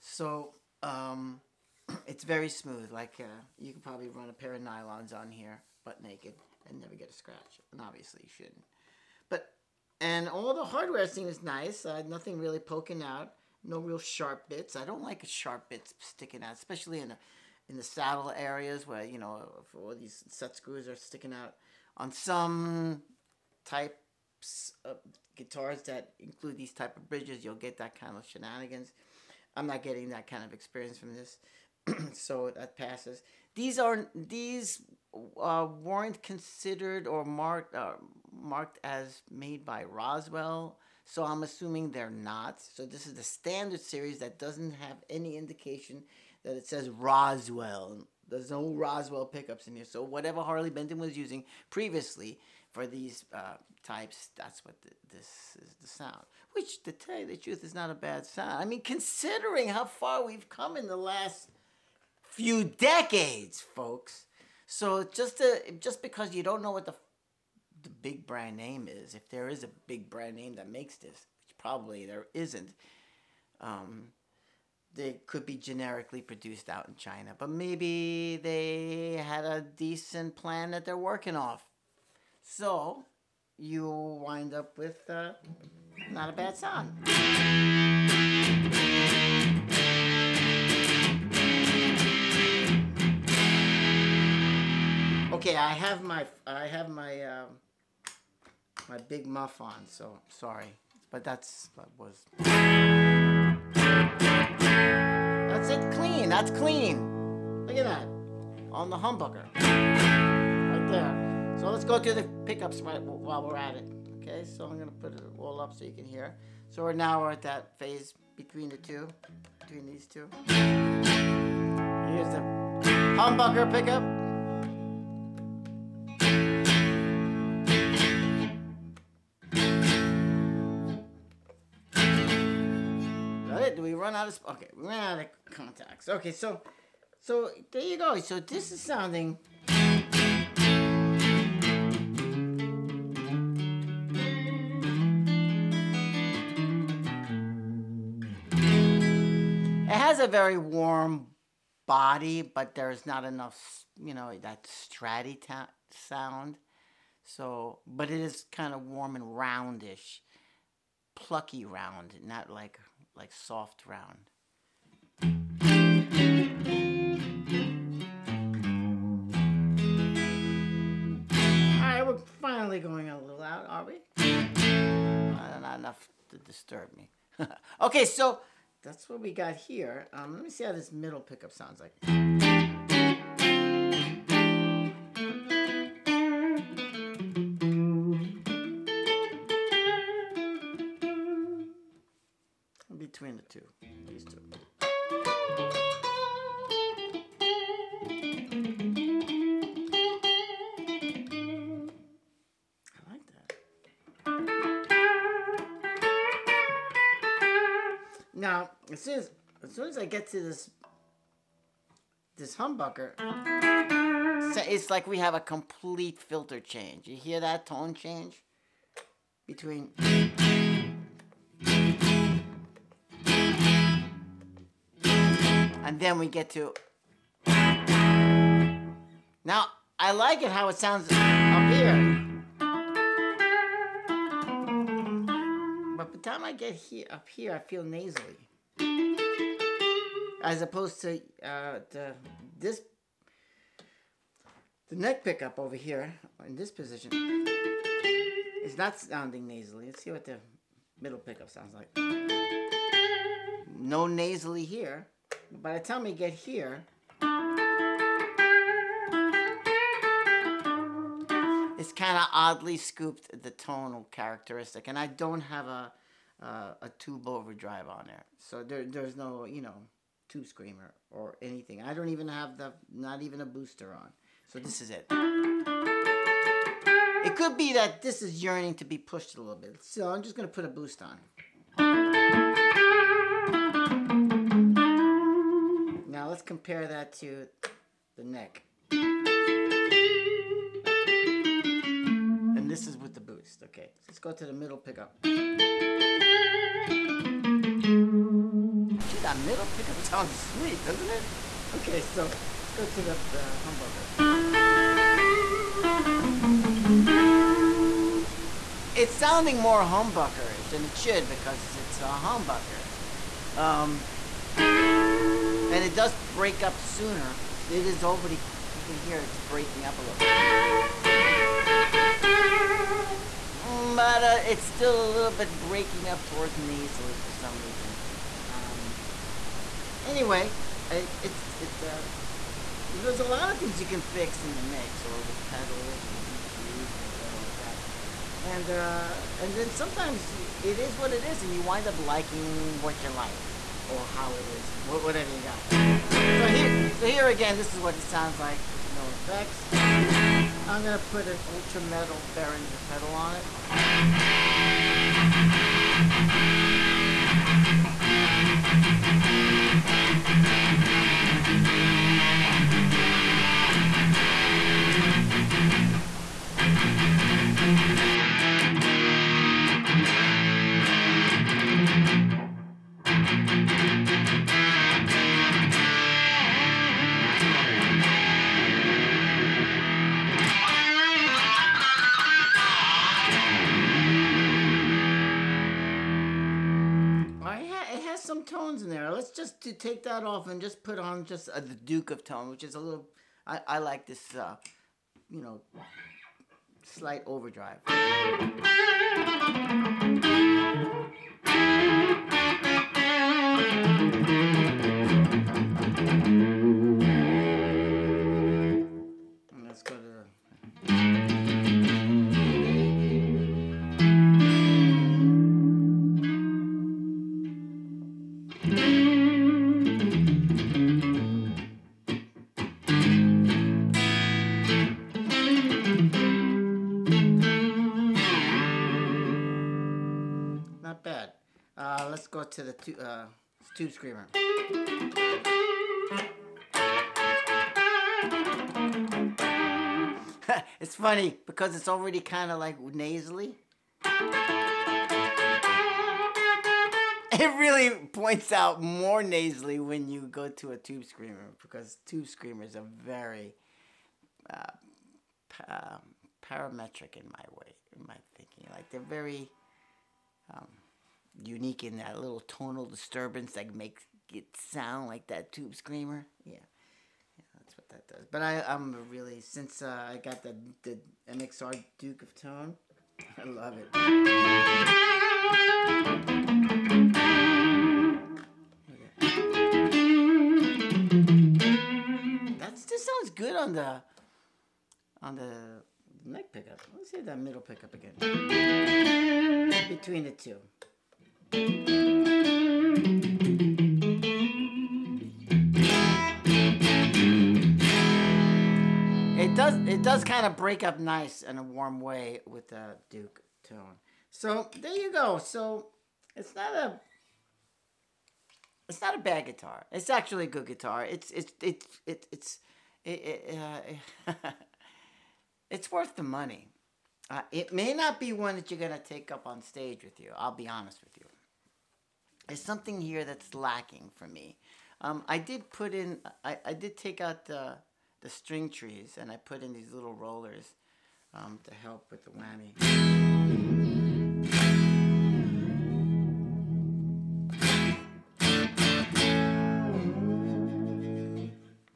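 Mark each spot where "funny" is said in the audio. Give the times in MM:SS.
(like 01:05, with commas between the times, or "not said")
07:20.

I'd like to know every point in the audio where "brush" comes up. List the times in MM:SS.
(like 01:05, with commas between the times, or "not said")
not said.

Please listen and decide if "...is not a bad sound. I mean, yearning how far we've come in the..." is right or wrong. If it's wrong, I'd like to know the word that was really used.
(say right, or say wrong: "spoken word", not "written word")
wrong: "considering", not "yearning".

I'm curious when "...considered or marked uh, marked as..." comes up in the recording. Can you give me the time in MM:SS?
00:36.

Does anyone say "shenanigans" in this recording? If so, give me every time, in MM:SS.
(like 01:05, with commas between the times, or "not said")
00:28.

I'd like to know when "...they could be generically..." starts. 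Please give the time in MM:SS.
01:14.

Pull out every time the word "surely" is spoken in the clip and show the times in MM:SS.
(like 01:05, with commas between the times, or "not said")
not said.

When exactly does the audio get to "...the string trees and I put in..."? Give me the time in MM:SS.
08:48.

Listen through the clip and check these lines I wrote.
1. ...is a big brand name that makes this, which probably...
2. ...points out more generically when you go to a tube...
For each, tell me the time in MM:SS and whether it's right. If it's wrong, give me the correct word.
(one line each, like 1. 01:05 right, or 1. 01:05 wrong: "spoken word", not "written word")
1. 01:09 right
2. 07:28 wrong: "nasally", not "generically".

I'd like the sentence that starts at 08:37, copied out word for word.
Uh, it may not be one that you're gonna take up on stage with you.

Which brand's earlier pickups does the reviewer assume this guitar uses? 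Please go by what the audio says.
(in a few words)
Harley Benton.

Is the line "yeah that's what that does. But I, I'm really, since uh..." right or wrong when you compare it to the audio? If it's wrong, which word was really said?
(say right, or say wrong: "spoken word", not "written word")
right.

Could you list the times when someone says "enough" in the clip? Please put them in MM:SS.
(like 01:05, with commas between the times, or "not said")
02:33, 02:55.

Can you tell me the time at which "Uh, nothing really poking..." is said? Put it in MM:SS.
00:11.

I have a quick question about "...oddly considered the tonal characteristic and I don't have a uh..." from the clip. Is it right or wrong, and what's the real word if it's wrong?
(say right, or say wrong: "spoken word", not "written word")
wrong: "scooped", not "considered".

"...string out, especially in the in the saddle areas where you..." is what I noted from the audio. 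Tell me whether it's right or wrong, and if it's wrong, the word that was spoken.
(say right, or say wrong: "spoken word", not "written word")
wrong: "sticking", not "string".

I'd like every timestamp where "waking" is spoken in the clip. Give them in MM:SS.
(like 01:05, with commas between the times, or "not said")
not said.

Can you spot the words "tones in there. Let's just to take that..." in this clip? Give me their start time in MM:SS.
06:28.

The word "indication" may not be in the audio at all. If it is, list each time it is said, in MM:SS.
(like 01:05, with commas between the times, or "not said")
00:45.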